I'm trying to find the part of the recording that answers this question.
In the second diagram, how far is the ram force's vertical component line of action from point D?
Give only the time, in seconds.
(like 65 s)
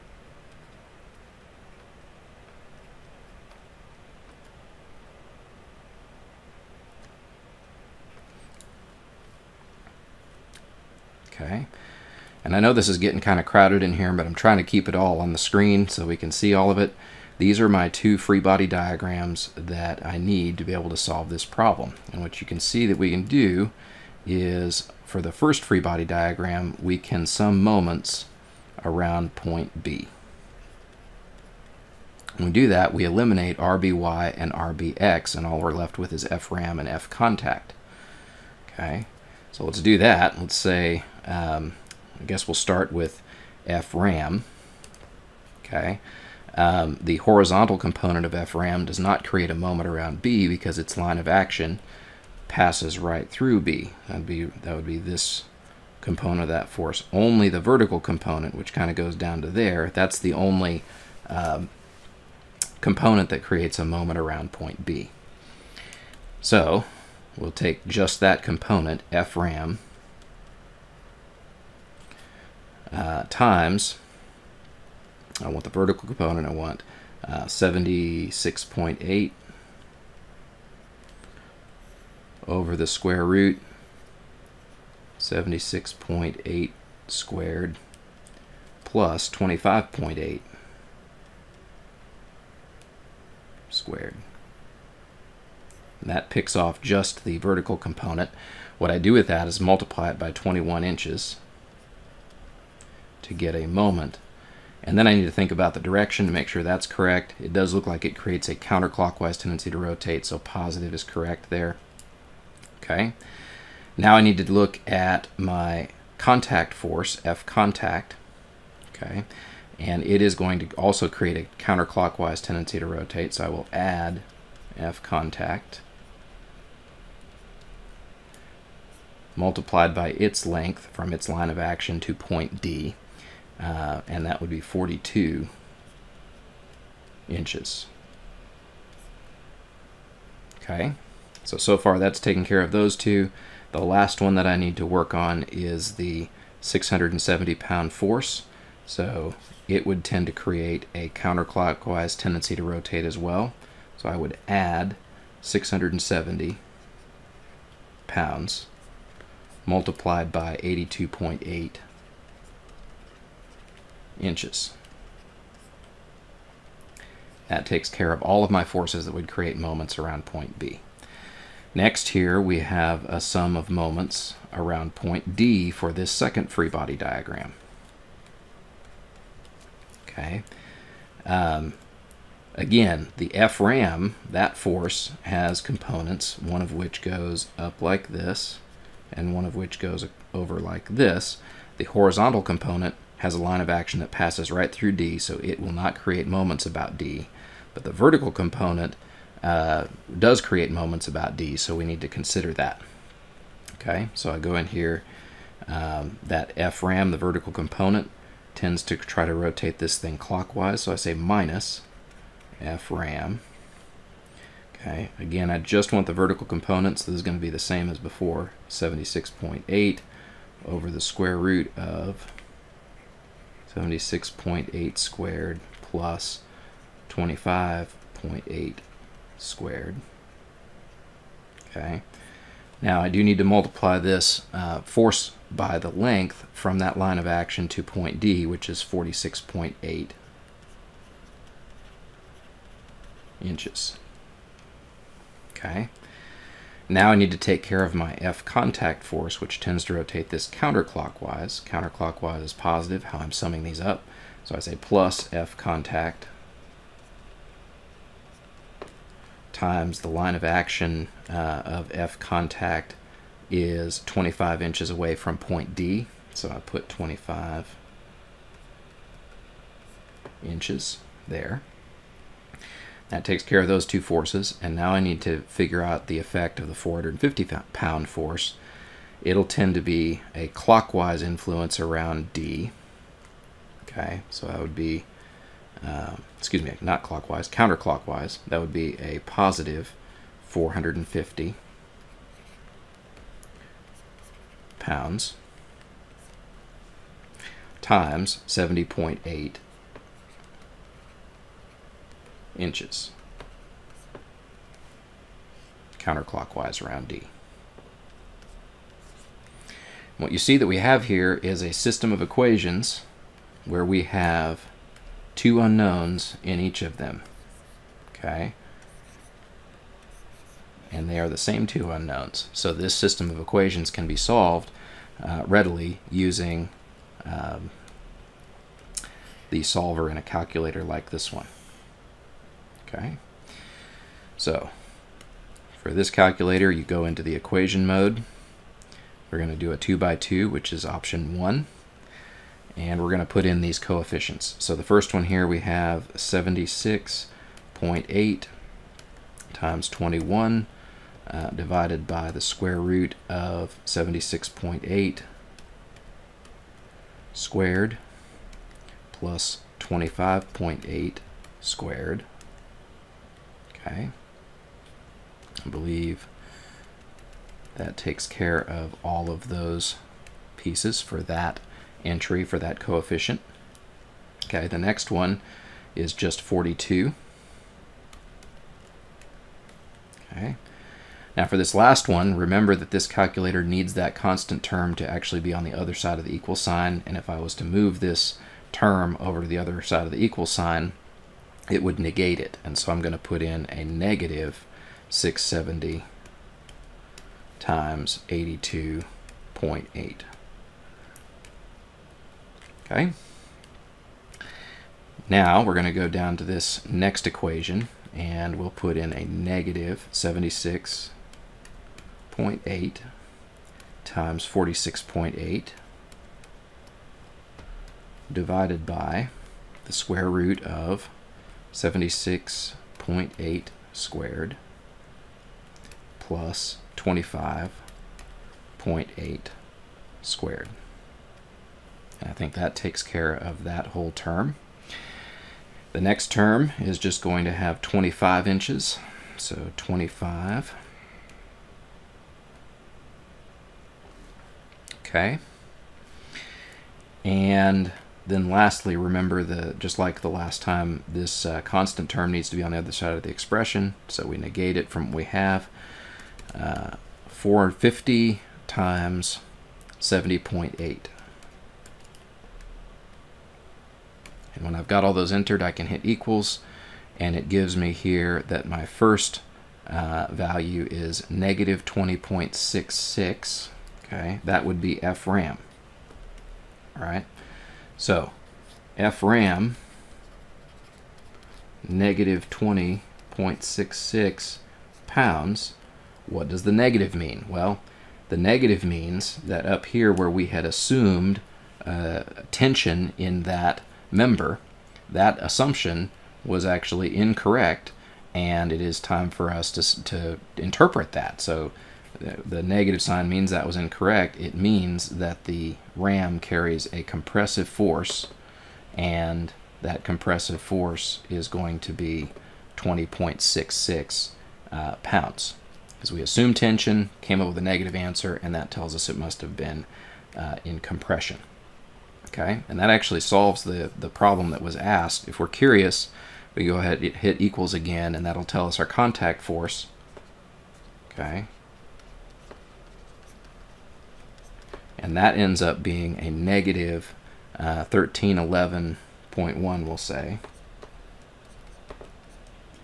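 238 s.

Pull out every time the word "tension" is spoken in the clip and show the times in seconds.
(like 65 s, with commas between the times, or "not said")
492 s, 516 s.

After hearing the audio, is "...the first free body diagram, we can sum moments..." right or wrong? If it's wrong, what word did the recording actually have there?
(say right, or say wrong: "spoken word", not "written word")
right.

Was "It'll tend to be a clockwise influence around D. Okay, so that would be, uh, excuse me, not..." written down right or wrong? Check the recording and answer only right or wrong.
right.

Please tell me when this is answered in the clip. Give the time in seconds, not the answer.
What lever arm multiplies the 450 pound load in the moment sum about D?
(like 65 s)
298 s.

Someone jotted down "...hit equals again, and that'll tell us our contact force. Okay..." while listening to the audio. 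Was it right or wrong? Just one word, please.
right.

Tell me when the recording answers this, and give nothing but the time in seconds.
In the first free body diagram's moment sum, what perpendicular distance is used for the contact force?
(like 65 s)
134 s.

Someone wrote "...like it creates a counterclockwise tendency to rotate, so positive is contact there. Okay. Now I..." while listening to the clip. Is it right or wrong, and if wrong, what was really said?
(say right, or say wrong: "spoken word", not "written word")
wrong: "correct", not "contact".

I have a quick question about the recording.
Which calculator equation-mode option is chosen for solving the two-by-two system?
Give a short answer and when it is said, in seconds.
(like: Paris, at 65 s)
option 1, at 340 s.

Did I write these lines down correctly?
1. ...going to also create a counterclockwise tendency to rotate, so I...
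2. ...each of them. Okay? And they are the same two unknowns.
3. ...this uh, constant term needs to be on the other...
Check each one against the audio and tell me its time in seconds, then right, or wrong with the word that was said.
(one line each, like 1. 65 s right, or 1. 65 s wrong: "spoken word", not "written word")
1. 120 s right
2. 316 s right
3. 451 s right.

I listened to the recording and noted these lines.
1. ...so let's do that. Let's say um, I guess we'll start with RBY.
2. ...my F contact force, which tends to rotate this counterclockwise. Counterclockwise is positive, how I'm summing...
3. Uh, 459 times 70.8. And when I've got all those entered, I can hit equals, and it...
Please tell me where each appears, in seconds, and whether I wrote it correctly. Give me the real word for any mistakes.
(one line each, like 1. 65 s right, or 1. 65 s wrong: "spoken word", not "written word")
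1. 39 s wrong: "FRAM", not "RBY"
2. 247 s right
3. 456 s wrong: "450", not "459".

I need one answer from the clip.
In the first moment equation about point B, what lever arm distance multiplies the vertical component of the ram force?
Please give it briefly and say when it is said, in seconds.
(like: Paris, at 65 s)
21 inches, at 100 s.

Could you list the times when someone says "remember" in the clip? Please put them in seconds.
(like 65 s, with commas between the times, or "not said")
382 s, 448 s.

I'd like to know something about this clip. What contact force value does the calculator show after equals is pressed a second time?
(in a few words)
-1311.1.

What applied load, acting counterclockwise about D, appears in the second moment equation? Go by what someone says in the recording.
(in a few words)
450 pounds.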